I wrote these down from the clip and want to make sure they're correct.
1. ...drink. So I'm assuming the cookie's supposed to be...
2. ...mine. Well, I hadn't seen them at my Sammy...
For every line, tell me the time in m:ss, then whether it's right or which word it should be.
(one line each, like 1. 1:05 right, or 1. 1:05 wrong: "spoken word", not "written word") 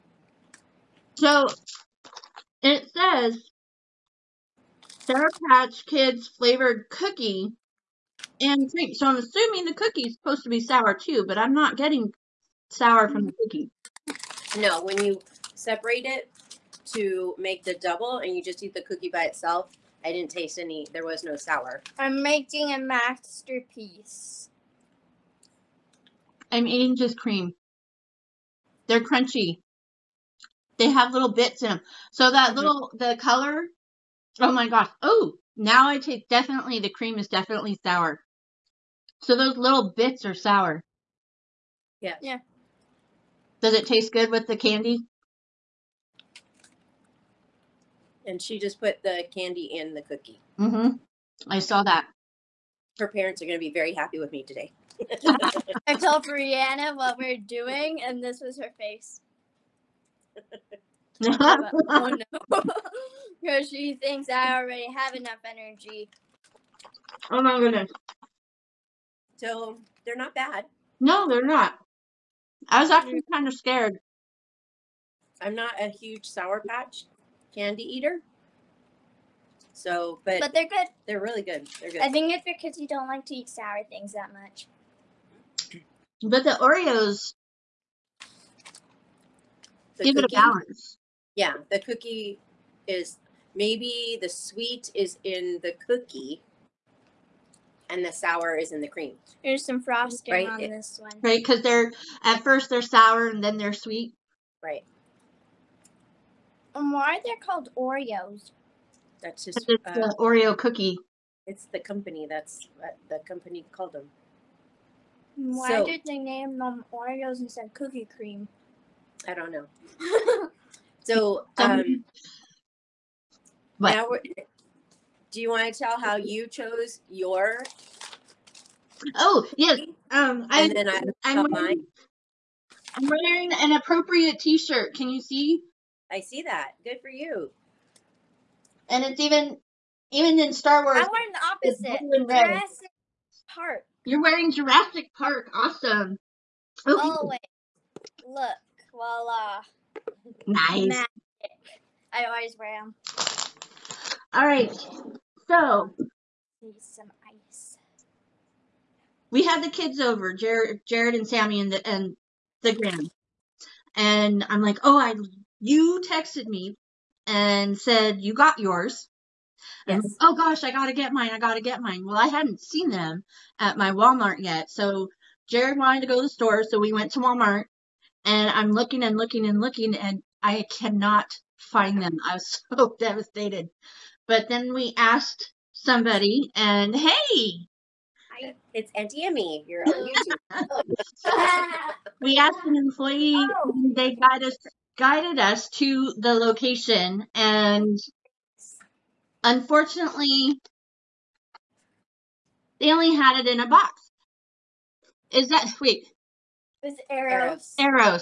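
1. 0:08 right
2. 2:51 wrong: "Walmart", not "Sammy".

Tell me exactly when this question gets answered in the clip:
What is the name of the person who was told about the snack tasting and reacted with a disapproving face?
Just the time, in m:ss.
0:56.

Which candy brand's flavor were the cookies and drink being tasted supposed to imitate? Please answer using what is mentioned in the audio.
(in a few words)
Sour Patch Kids.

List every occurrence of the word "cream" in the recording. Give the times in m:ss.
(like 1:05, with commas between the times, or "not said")
0:27, 0:36, 1:38, 1:58.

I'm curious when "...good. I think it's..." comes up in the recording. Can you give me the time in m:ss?
1:21.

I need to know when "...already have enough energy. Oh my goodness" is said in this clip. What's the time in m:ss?
1:04.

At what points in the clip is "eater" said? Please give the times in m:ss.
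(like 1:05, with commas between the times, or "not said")
1:17.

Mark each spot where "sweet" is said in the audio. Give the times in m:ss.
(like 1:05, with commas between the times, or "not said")
1:34, 1:43, 3:25.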